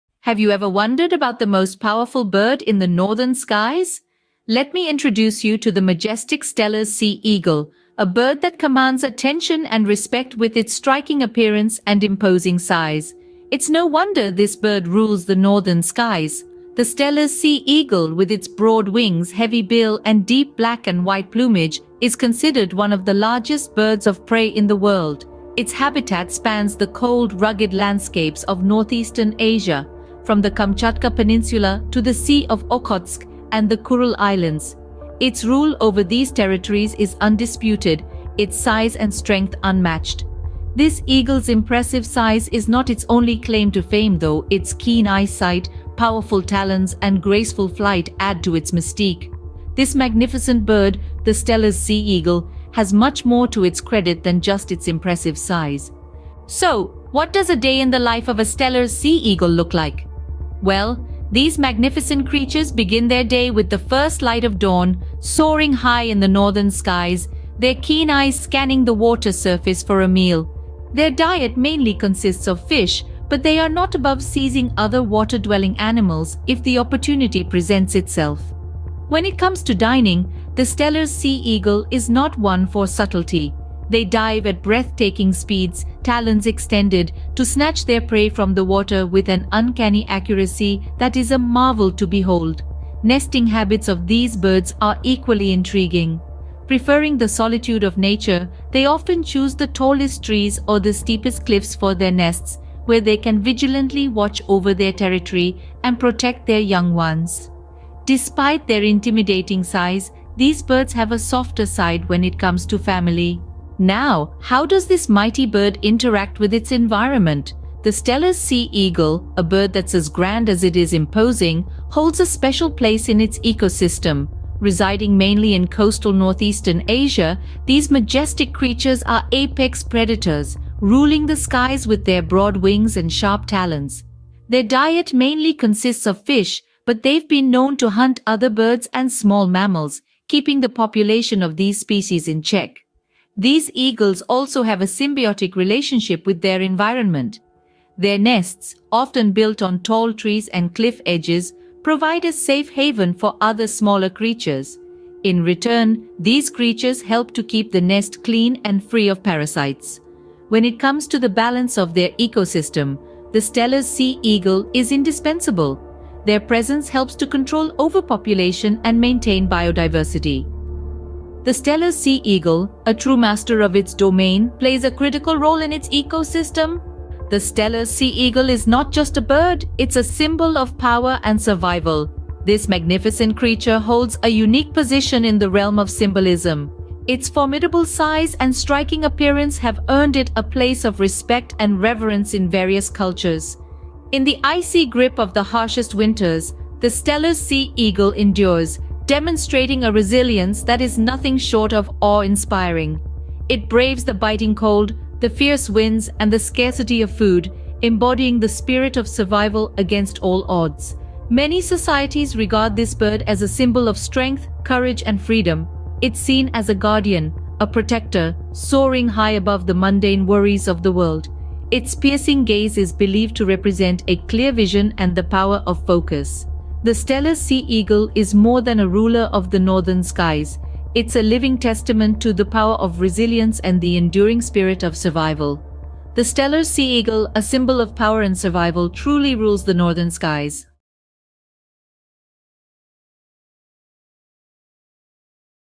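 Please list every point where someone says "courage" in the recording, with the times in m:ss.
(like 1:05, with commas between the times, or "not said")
3:34.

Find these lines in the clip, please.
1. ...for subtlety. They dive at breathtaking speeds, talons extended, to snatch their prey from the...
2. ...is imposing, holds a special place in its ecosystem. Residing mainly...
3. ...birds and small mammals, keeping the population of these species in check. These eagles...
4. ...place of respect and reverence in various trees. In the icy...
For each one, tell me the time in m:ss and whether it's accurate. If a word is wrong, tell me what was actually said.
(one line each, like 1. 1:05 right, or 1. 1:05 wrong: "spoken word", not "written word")
1. 1:22 right
2. 2:00 right
3. 2:18 right
4. 3:10 wrong: "cultures", not "trees".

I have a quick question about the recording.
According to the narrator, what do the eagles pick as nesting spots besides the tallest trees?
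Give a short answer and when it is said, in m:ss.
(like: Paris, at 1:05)
Steepest cliffs, at 1:40.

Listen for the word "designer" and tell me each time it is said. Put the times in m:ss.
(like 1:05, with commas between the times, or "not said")
not said.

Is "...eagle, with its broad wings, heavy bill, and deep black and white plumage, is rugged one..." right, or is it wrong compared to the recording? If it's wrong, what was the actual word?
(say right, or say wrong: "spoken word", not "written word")
wrong: "considered", not "rugged".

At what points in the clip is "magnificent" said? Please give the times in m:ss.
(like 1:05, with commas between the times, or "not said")
0:49, 1:01, 3:02.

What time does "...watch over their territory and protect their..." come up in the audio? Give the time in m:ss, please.
1:44.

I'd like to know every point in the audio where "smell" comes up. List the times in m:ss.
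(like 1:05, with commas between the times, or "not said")
not said.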